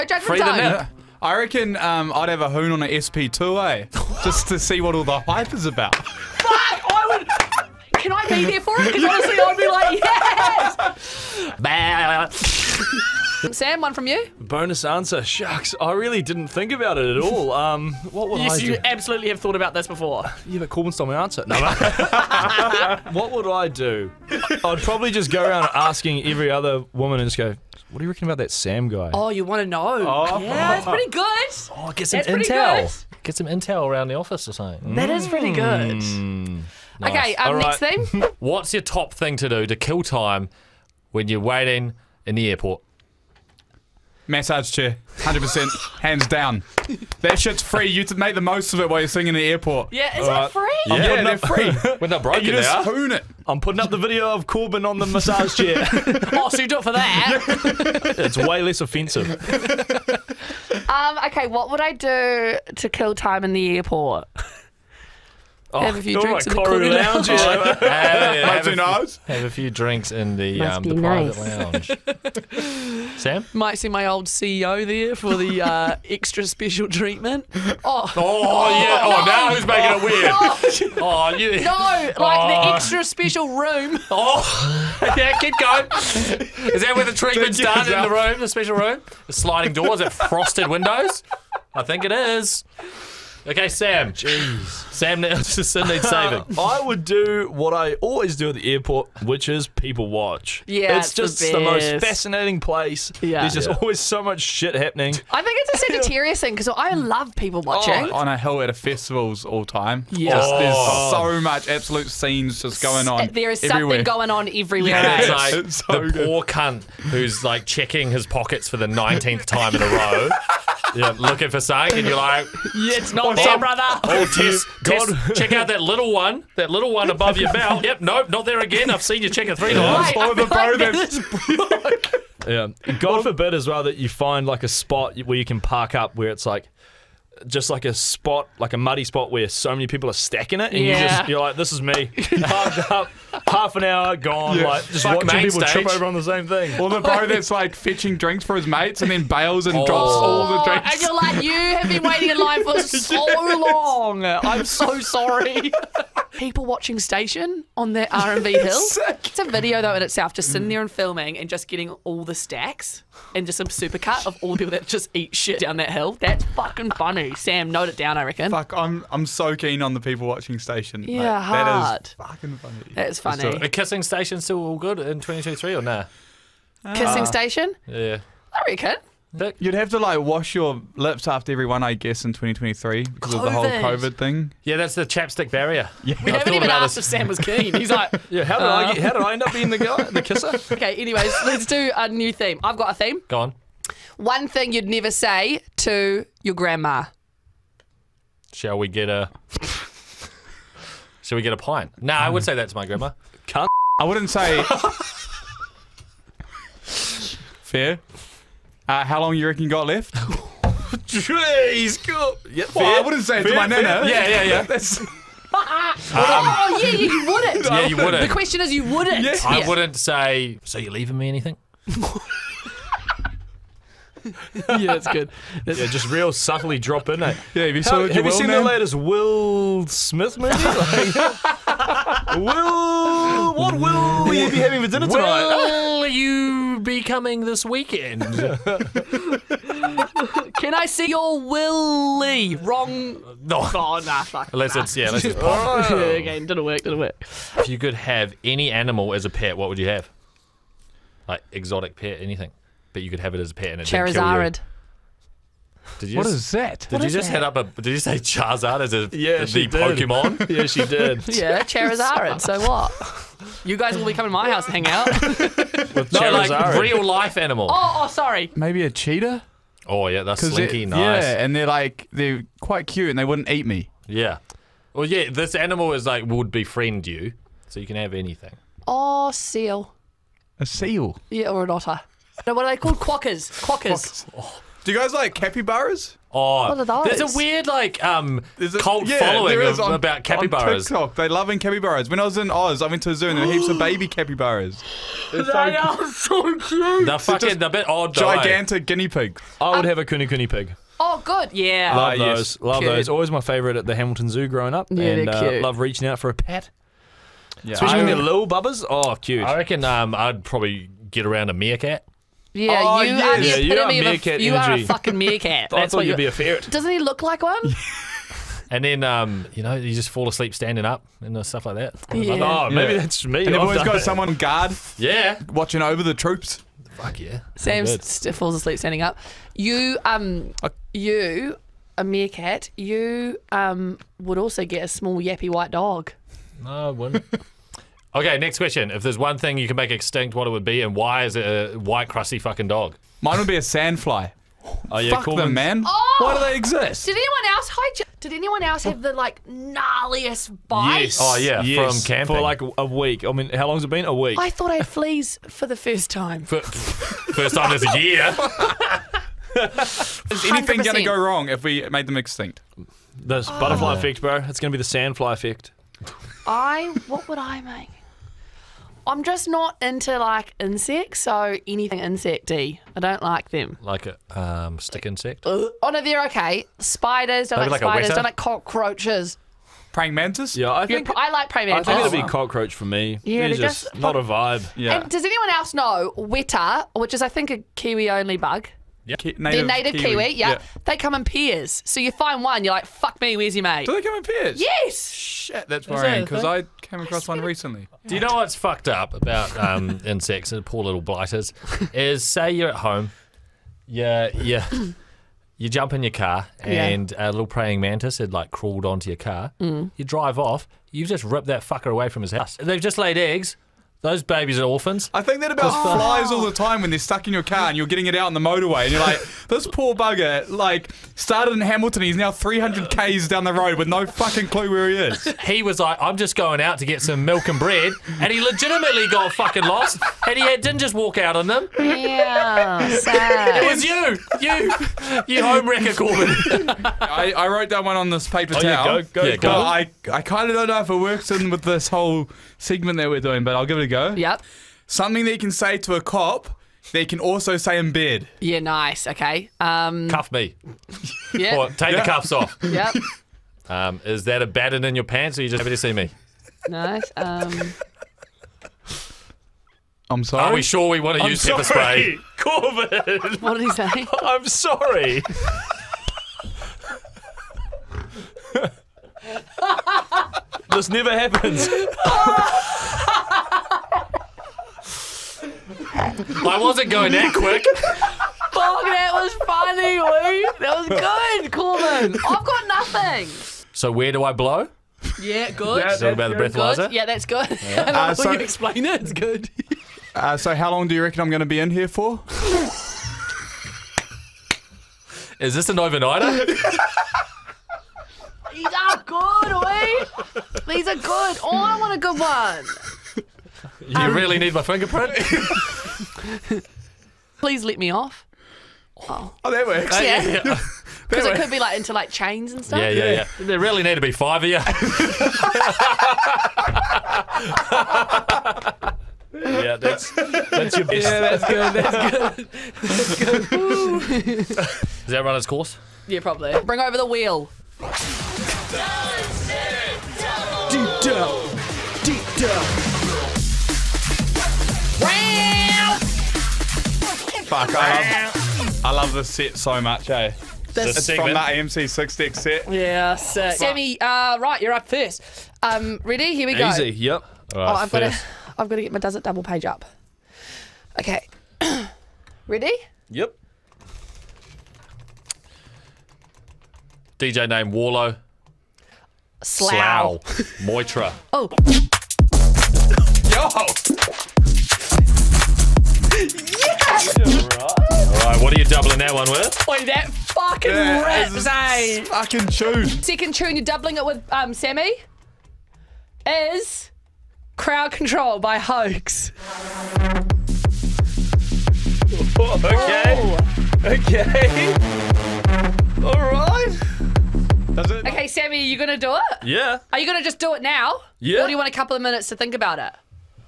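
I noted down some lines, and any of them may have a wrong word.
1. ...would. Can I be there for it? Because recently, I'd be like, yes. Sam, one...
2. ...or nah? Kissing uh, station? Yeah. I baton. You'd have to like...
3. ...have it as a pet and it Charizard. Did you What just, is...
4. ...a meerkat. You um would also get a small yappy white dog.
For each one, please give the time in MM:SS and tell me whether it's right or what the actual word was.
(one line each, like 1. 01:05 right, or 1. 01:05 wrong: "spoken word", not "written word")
1. 00:07 wrong: "honestly", not "recently"
2. 02:55 wrong: "reckon", not "baton"
3. 04:13 right
4. 05:31 right.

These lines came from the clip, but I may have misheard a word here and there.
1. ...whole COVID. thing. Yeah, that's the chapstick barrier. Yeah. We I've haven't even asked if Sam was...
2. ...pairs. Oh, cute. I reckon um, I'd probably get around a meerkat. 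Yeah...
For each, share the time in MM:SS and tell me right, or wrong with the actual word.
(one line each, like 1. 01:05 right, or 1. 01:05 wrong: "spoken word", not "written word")
1. 03:03 right
2. 05:08 wrong: "bubbers", not "pairs".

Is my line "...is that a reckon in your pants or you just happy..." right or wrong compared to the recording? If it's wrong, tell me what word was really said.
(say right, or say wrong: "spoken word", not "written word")
wrong: "baton", not "reckon".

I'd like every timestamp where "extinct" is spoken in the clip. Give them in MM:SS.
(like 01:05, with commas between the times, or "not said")
05:39, 06:02.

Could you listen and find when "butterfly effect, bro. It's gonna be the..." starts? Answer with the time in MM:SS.
06:03.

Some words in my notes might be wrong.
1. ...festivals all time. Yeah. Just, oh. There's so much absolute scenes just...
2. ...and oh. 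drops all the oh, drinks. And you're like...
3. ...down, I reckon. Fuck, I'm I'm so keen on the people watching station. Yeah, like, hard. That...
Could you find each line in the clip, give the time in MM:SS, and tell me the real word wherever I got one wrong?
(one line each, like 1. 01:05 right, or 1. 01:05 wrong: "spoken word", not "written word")
1. 01:48 right
2. 02:29 right
3. 02:47 right.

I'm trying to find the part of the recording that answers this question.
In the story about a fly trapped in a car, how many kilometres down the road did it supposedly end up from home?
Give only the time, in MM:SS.
07:02.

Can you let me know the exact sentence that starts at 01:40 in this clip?
Yeah, it's, it's just the, the, most fascinating place.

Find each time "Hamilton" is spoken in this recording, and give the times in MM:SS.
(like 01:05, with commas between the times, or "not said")
05:03, 07:01.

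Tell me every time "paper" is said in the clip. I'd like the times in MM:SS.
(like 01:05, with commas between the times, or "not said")
07:18.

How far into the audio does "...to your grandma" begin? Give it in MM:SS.
03:15.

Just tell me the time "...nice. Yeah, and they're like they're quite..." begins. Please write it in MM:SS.
04:30.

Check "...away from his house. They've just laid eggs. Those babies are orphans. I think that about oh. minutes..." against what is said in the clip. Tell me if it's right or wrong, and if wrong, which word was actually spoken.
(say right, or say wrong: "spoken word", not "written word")
wrong: "flies", not "minutes".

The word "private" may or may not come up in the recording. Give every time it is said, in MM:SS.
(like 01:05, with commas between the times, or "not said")
01:06, 01:11.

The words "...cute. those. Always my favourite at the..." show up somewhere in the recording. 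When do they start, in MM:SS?
05:02.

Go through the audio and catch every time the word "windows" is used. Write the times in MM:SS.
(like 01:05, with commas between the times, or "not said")
01:30.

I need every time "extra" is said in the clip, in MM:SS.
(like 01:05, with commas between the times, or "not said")
01:16, 01:22.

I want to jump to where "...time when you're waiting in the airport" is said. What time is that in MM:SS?
00:40.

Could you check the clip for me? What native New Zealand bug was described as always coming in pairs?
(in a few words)
weta.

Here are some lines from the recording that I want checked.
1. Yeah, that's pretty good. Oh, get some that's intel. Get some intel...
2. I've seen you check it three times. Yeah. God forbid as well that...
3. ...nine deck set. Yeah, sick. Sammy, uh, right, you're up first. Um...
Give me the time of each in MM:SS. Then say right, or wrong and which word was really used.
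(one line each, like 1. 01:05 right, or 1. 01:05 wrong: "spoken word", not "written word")
1. 00:30 right
2. 02:08 right
3. 09:01 wrong: "six", not "nine".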